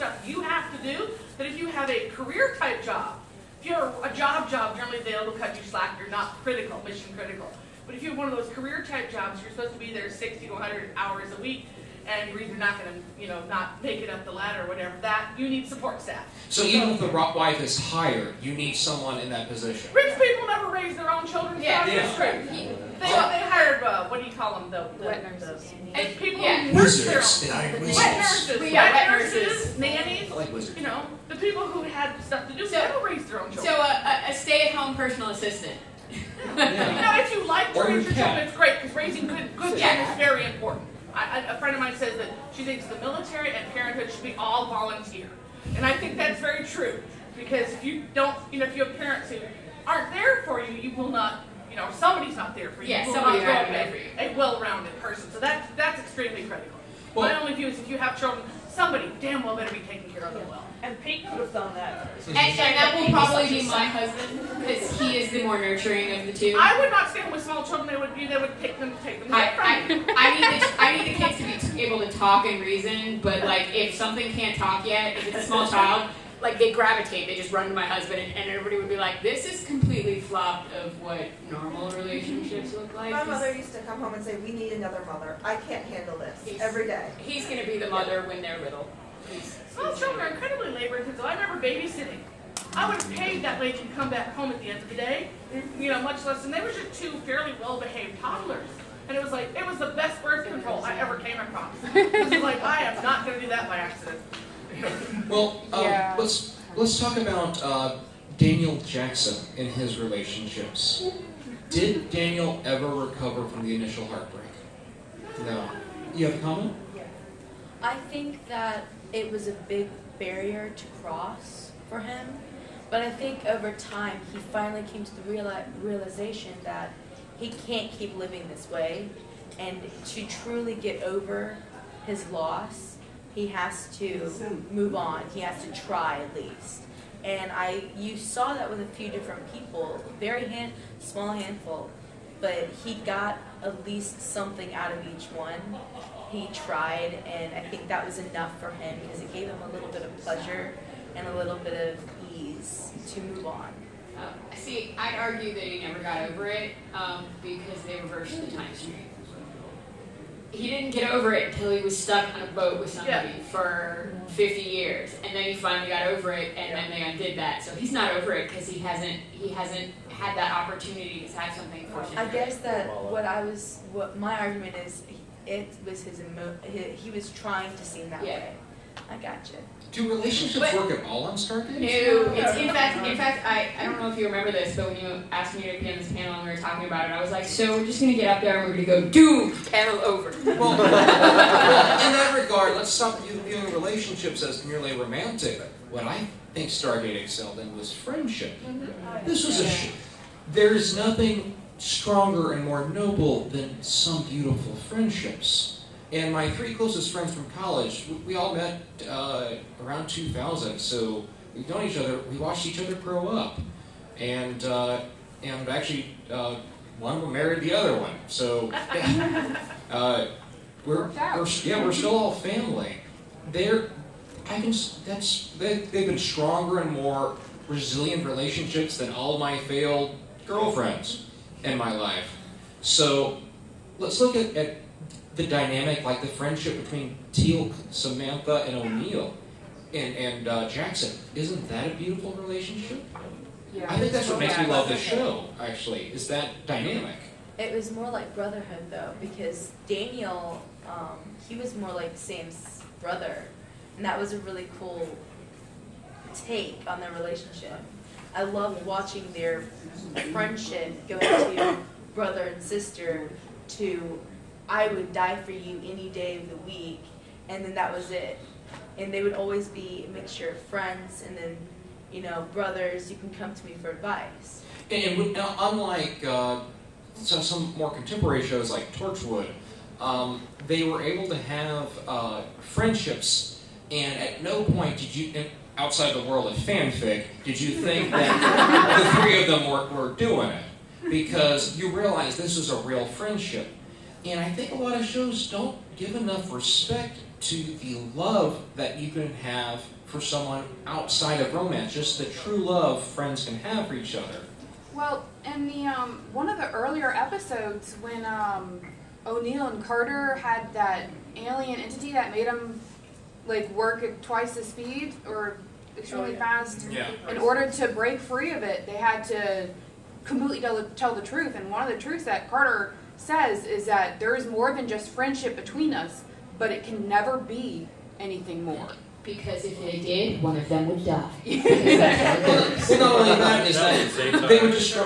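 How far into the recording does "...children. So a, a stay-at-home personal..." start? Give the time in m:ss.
0:33.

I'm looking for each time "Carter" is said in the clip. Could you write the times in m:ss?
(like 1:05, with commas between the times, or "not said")
5:09, 5:22.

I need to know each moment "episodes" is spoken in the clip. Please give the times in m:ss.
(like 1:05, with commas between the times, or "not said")
5:07.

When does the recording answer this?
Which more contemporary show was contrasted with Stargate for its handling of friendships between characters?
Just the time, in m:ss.
4:38.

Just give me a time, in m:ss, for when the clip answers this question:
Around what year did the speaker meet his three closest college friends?
3:30.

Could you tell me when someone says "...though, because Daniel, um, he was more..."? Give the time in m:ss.
4:08.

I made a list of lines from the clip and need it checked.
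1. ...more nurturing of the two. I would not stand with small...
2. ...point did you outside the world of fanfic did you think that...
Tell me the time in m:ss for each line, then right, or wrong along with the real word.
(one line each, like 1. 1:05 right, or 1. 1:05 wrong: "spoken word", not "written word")
1. 1:05 right
2. 4:44 right.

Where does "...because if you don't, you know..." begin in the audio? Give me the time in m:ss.
0:47.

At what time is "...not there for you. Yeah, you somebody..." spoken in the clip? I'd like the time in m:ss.
0:52.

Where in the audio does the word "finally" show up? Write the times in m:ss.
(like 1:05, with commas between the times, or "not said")
2:04, 2:45.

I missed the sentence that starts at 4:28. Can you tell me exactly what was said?
And they would always be a mixture of friends and then, you know, brothers, you can come to me for advice.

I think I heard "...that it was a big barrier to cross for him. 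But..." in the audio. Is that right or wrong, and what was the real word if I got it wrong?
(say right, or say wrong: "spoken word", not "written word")
right.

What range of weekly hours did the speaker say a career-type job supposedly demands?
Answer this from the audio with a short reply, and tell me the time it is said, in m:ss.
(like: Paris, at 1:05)
60 to 100, at 0:10.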